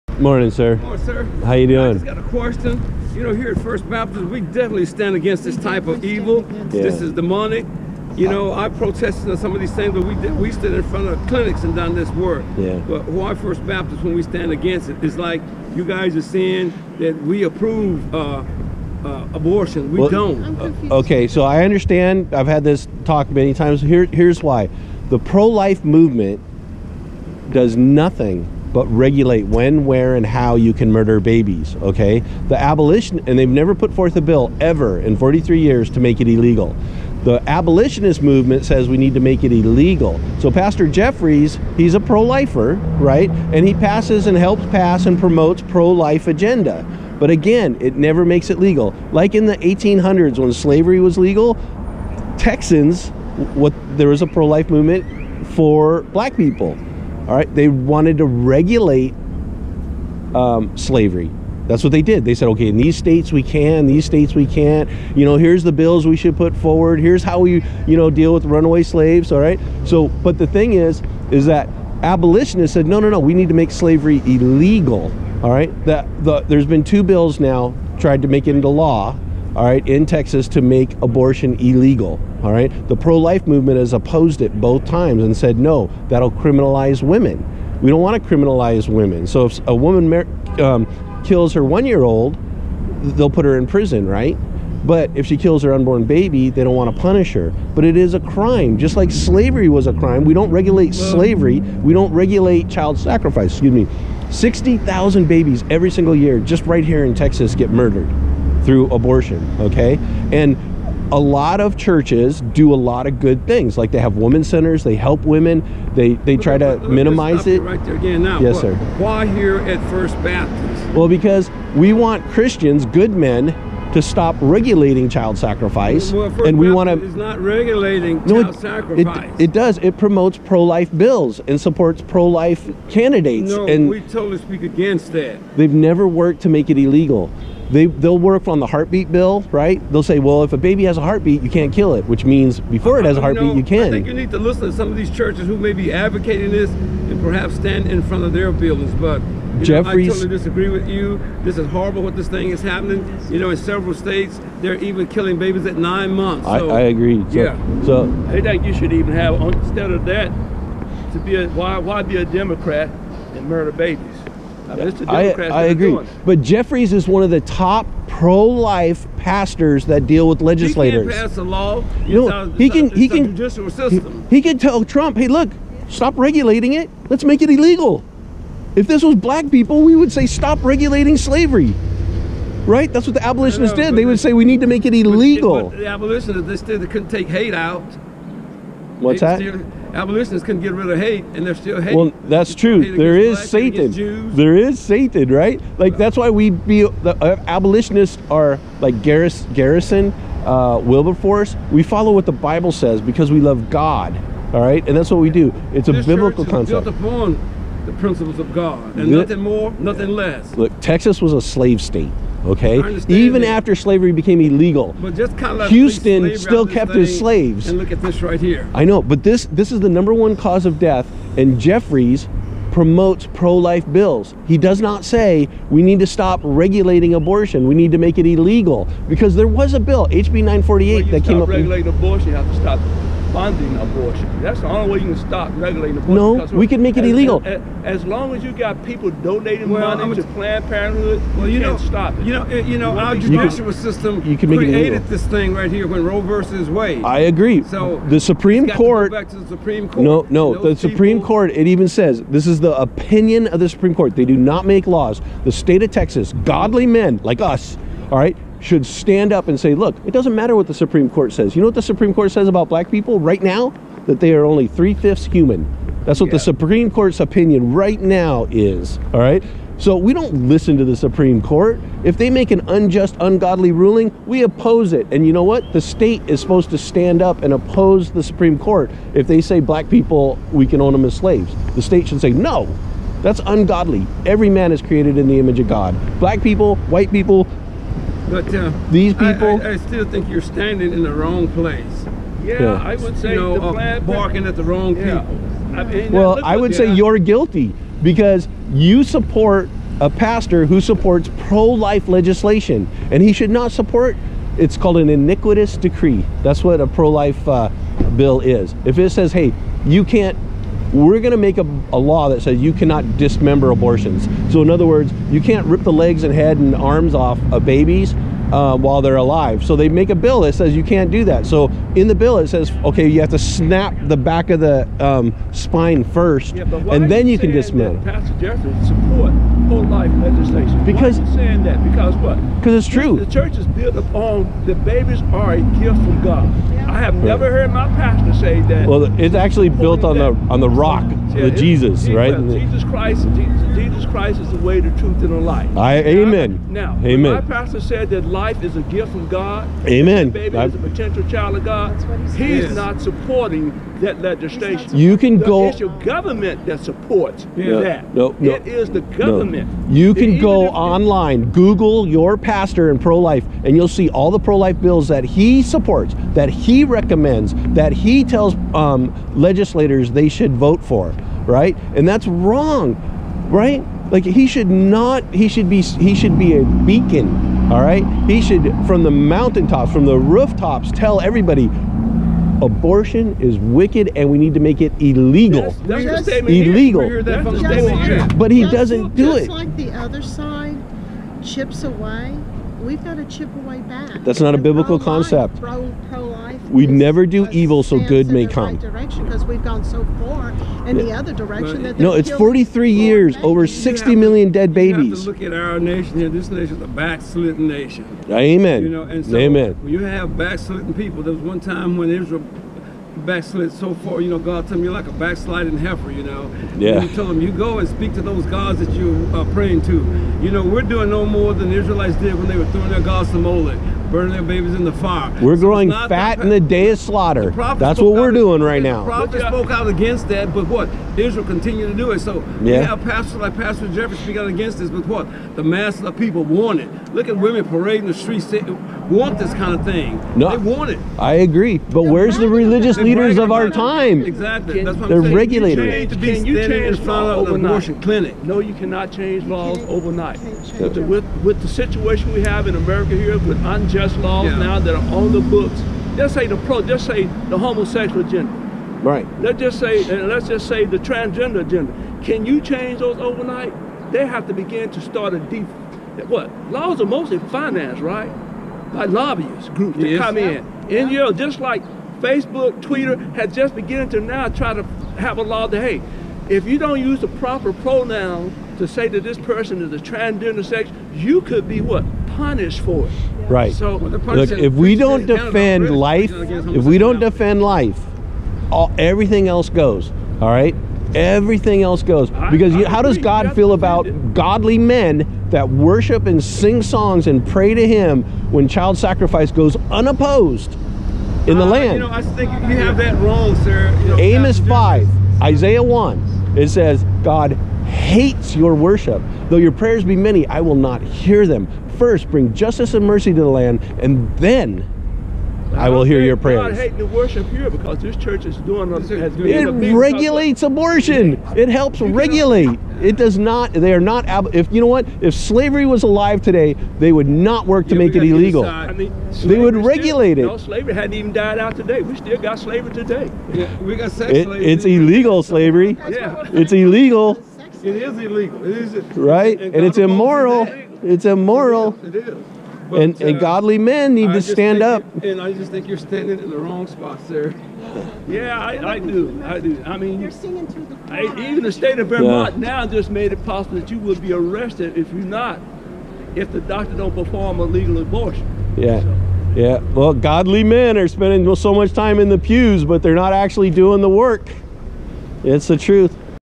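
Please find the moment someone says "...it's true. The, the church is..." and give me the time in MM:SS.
05:32.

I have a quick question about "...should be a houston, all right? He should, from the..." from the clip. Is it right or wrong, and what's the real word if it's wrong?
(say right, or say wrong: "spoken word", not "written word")
wrong: "beacon", not "houston".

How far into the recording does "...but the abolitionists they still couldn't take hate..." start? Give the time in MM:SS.
03:05.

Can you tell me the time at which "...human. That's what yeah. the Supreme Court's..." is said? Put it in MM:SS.
04:25.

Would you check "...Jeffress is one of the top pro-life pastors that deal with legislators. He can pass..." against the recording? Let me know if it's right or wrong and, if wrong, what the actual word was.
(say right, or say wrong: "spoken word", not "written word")
right.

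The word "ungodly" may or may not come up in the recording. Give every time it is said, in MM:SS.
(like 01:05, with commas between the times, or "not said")
04:33, 04:43.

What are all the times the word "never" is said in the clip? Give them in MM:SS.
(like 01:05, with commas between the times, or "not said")
00:33, 00:47, 02:15, 05:37, 06:36.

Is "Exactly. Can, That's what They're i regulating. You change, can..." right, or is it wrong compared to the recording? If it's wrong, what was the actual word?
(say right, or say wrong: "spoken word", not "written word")
right.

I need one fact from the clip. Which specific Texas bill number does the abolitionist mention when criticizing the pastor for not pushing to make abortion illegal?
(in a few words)
HB 948.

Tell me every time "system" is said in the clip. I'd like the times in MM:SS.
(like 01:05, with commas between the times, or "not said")
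02:53, 04:03.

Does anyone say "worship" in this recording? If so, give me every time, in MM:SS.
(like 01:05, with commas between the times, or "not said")
08:15, 08:28, 08:37.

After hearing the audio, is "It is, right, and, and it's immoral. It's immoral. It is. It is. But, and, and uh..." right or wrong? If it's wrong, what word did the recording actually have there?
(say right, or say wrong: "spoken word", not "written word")
right.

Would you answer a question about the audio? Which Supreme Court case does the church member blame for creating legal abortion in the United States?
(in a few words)
Roe versus Wade.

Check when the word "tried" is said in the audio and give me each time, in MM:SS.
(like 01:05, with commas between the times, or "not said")
01:17.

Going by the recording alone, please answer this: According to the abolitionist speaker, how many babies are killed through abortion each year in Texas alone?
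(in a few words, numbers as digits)
60,000.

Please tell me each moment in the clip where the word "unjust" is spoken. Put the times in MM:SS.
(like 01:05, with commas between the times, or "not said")
04:32, 07:33.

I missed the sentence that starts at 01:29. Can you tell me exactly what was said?
So if a woman um, kills her one-year-old, they'll put her in prison, right?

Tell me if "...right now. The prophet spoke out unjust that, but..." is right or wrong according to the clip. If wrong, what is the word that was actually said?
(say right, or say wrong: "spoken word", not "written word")
wrong: "against", not "unjust".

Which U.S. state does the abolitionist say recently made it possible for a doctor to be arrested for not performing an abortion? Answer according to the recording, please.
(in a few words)
Vermont.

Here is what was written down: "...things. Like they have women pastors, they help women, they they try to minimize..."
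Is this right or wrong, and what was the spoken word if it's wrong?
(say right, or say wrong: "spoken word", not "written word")
wrong: "centers", not "pastors".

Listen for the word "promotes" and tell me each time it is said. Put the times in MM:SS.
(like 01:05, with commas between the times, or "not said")
00:45, 02:09, 03:42.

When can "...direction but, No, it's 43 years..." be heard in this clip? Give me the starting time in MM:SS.
06:41.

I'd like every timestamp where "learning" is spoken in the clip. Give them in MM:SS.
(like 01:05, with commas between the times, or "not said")
not said.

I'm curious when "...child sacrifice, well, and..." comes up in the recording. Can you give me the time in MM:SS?
02:05.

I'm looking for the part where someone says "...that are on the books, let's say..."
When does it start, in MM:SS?
07:34.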